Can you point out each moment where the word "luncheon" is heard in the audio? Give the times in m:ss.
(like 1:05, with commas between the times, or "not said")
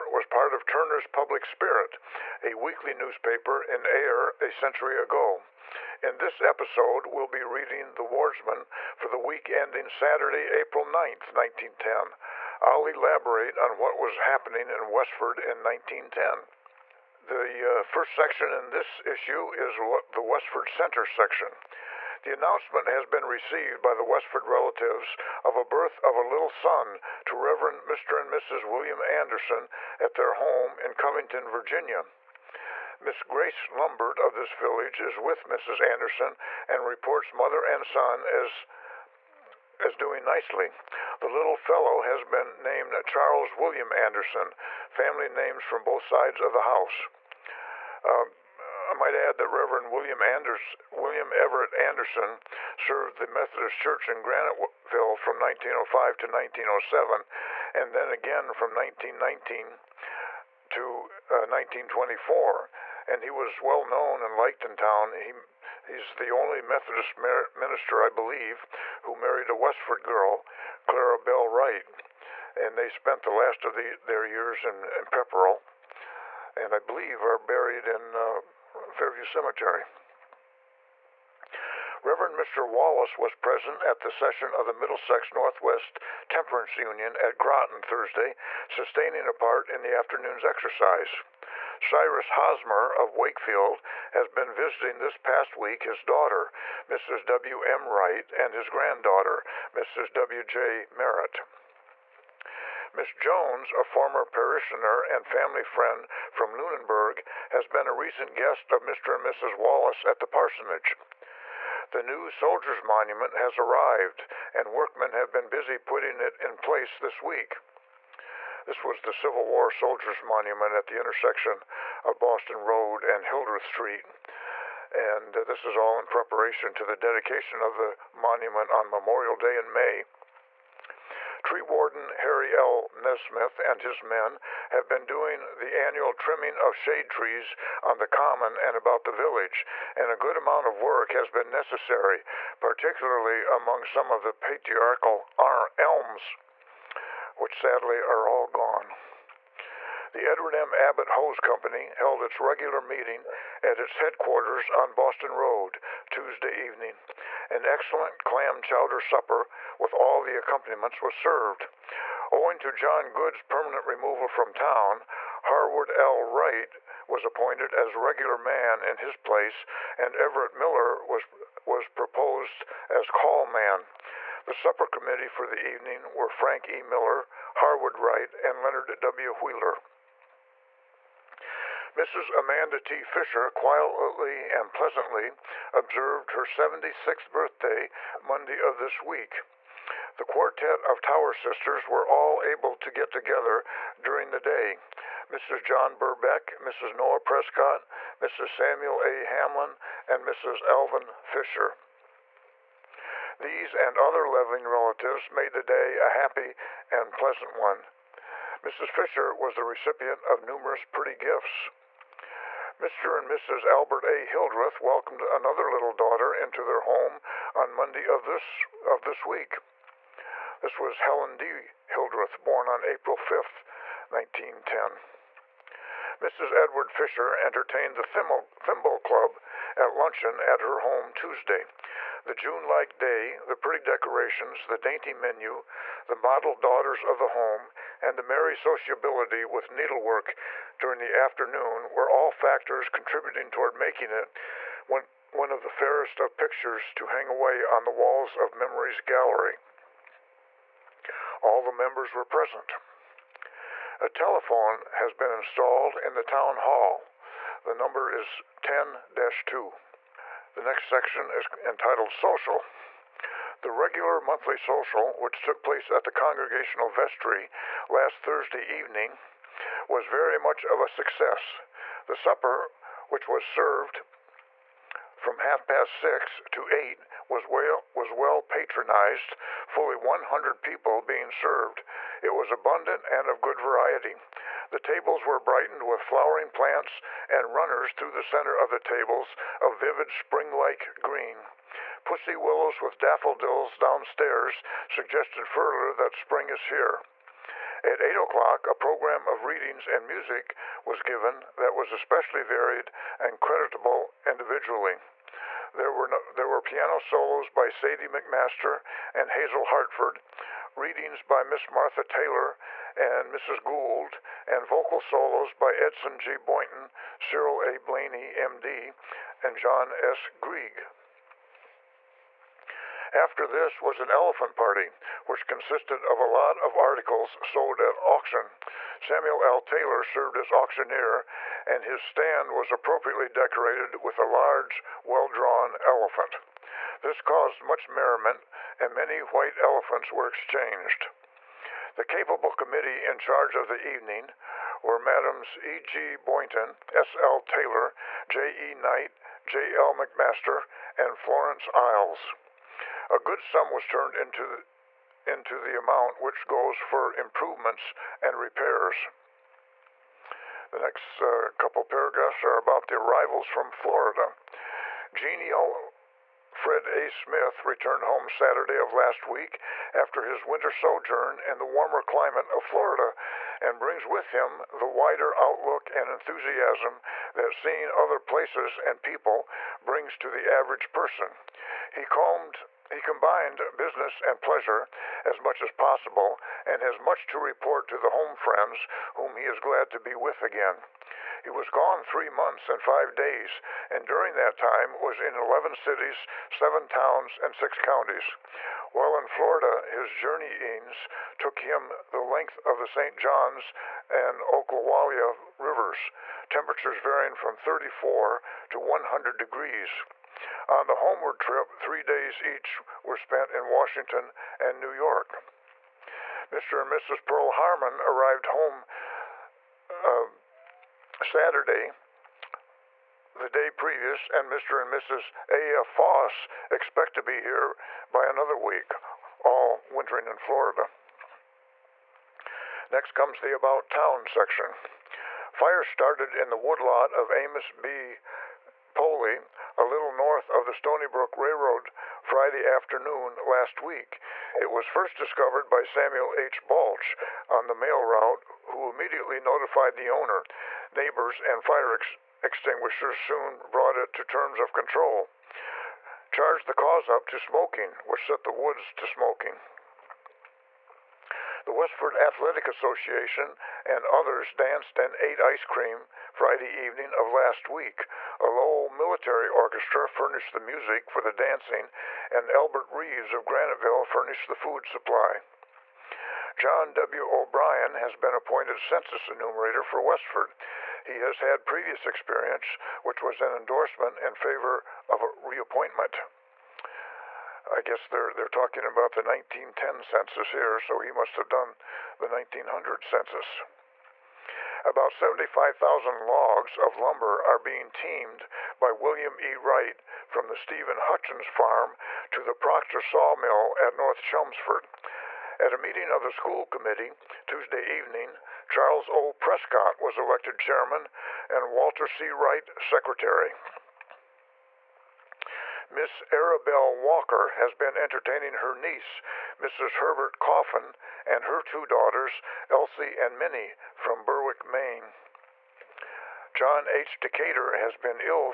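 3:49.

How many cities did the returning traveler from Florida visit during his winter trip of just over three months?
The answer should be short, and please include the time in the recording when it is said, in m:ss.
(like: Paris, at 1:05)
11, at 6:35.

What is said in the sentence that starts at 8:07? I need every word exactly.
I guess they're they're talking about the 1910 census here, so he must have done the 1900 census.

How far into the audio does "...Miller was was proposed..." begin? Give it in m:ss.
2:50.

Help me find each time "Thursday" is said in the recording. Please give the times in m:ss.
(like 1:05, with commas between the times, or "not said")
1:27, 4:28.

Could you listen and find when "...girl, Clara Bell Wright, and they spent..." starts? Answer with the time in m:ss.
1:10.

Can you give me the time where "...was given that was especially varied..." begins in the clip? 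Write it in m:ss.
5:00.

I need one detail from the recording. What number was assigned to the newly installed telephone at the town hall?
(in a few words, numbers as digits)
10 2.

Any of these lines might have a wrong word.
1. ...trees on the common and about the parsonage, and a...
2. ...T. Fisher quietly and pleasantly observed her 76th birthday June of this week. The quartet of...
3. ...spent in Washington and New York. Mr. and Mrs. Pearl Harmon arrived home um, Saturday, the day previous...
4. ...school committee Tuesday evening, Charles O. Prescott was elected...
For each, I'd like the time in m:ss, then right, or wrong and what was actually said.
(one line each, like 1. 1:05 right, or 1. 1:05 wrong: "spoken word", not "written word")
1. 2:17 wrong: "village", not "parsonage"
2. 3:02 wrong: "Monday", not "June"
3. 6:53 right
4. 8:26 right.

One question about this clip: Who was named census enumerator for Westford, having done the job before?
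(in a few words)
John W. O'Brien.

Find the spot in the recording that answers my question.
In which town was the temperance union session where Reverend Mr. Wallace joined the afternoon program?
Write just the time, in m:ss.
1:27.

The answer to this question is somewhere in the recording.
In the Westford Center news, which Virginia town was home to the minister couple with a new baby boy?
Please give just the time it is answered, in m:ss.
0:30.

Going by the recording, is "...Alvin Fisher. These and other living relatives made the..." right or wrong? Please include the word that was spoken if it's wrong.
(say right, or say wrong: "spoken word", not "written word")
right.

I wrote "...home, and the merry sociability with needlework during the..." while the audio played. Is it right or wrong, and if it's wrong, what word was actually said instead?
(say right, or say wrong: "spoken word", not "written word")
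right.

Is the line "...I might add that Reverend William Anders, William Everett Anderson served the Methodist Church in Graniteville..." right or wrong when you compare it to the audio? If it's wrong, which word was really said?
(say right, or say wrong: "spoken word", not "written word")
right.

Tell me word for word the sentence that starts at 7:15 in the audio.
Fire started in the woodlot of Amos B.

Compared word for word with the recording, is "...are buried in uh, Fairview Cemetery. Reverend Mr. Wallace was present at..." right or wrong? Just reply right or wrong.
right.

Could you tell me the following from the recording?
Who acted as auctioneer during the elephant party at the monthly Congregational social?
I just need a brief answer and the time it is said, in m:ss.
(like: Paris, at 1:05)
Samuel L. Taylor, at 5:29.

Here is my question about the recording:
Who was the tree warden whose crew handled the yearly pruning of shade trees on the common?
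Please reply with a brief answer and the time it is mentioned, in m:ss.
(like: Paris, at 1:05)
Harry L. Nesmith, at 2:12.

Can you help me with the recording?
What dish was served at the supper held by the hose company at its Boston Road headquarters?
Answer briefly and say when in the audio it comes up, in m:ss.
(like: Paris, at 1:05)
clam chowder, at 2:38.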